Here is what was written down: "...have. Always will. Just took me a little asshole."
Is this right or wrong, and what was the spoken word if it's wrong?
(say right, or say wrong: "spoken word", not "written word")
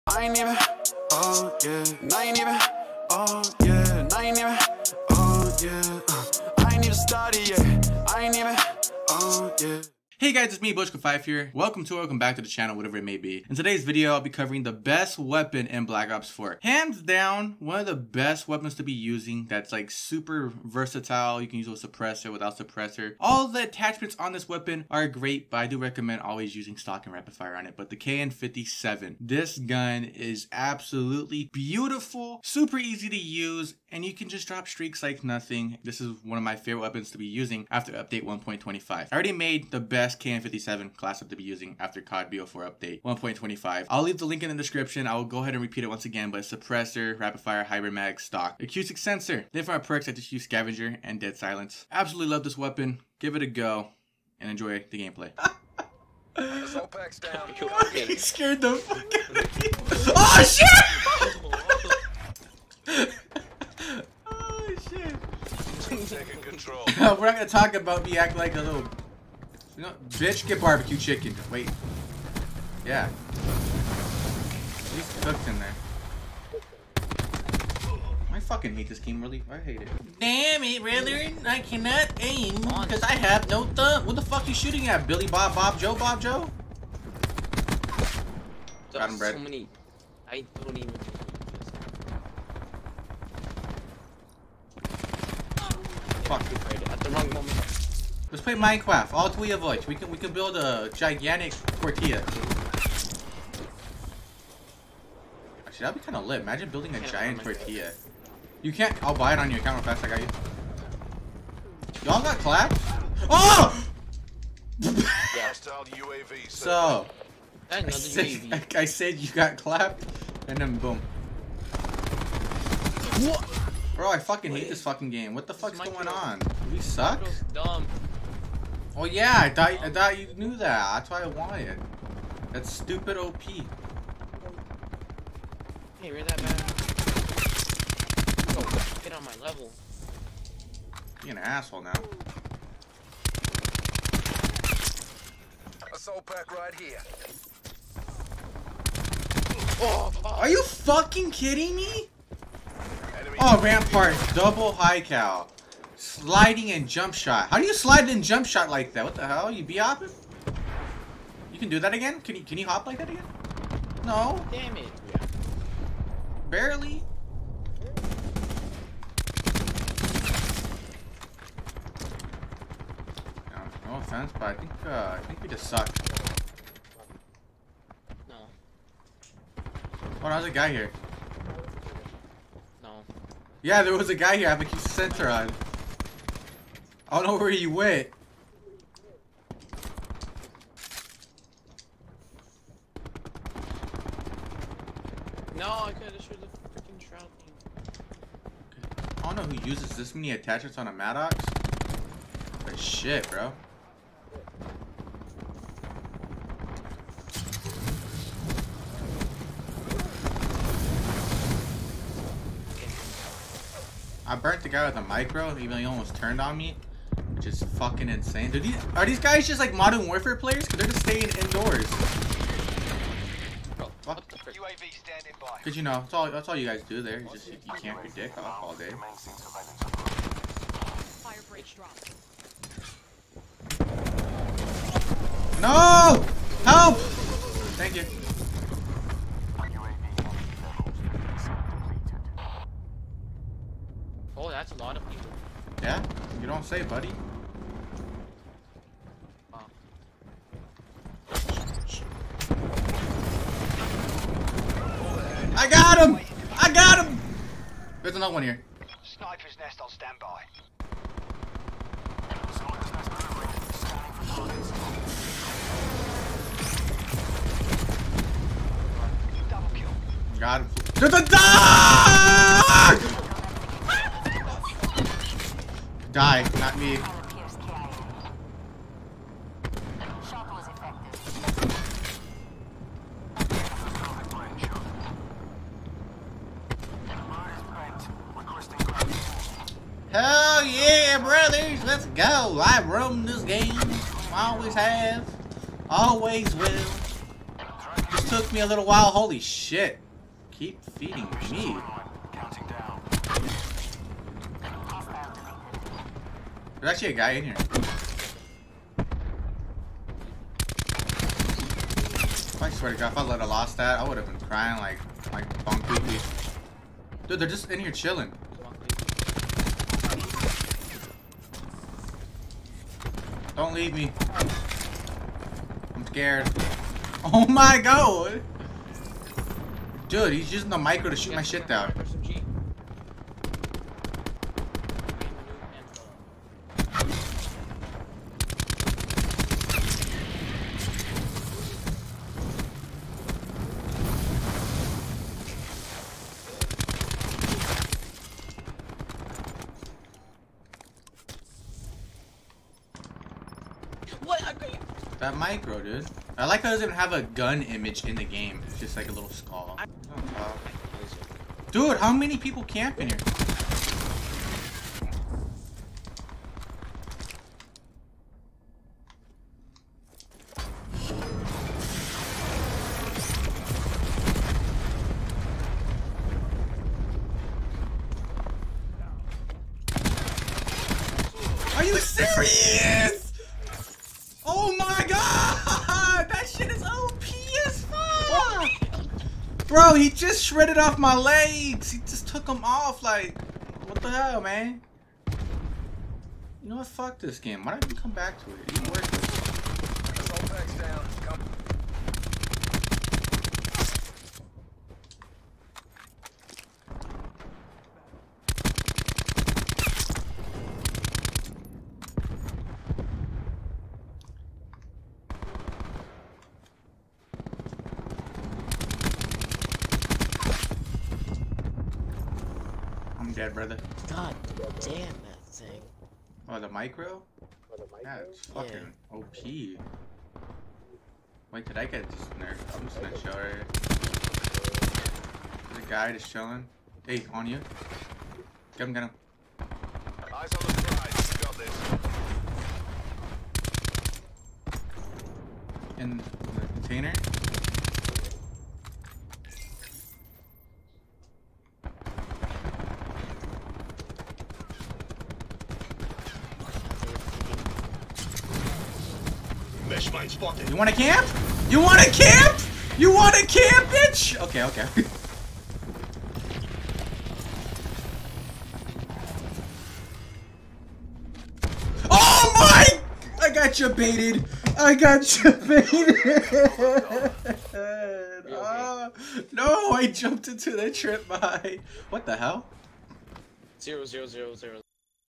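wrong: "while", not "asshole".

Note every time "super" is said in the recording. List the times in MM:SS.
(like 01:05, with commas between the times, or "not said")
00:19, 00:32.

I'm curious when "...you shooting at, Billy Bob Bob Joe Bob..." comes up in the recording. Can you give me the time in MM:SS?
01:24.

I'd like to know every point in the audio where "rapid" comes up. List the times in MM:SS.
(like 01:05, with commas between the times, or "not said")
00:27, 00:47.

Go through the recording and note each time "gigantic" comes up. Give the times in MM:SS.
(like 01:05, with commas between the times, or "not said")
01:40.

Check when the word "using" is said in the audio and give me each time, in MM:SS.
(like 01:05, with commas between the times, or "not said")
00:18, 00:26, 00:37, 00:41, 05:30.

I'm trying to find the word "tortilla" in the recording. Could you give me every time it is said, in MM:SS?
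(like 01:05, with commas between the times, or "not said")
01:41, 01:47.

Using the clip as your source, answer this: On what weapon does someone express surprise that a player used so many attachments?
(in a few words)
Maddox.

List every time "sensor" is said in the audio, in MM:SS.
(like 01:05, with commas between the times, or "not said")
00:48, 03:04.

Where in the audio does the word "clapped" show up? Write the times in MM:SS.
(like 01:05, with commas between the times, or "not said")
01:52, 01:59.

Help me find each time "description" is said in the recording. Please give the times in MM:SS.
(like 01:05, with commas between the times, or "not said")
00:44.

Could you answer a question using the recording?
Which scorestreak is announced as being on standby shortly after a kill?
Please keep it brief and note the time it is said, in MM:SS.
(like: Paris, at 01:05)
Sniper's nest, at 04:19.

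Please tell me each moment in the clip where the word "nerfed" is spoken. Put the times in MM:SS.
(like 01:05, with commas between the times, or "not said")
07:12.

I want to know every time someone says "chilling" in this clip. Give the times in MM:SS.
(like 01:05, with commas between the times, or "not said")
05:17, 07:16.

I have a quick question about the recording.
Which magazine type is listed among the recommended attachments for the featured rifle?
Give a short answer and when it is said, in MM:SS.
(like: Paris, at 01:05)
Hybrid mag, at 00:47.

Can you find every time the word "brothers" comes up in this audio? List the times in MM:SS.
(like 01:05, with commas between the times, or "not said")
04:51, 07:03.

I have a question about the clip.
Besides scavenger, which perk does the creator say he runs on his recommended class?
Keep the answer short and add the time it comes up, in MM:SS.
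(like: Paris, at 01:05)
Dead silence, at 00:51.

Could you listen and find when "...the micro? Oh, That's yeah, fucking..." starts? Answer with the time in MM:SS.
07:06.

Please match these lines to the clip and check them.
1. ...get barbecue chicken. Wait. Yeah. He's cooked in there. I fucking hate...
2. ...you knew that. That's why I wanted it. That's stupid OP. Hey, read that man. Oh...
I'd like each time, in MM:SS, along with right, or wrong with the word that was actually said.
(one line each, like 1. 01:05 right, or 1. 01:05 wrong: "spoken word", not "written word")
1. 01:10 right
2. 02:10 right.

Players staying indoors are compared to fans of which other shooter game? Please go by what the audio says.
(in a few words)
Modern Warfare.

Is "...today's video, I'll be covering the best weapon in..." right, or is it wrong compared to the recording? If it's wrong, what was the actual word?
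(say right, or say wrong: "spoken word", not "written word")
right.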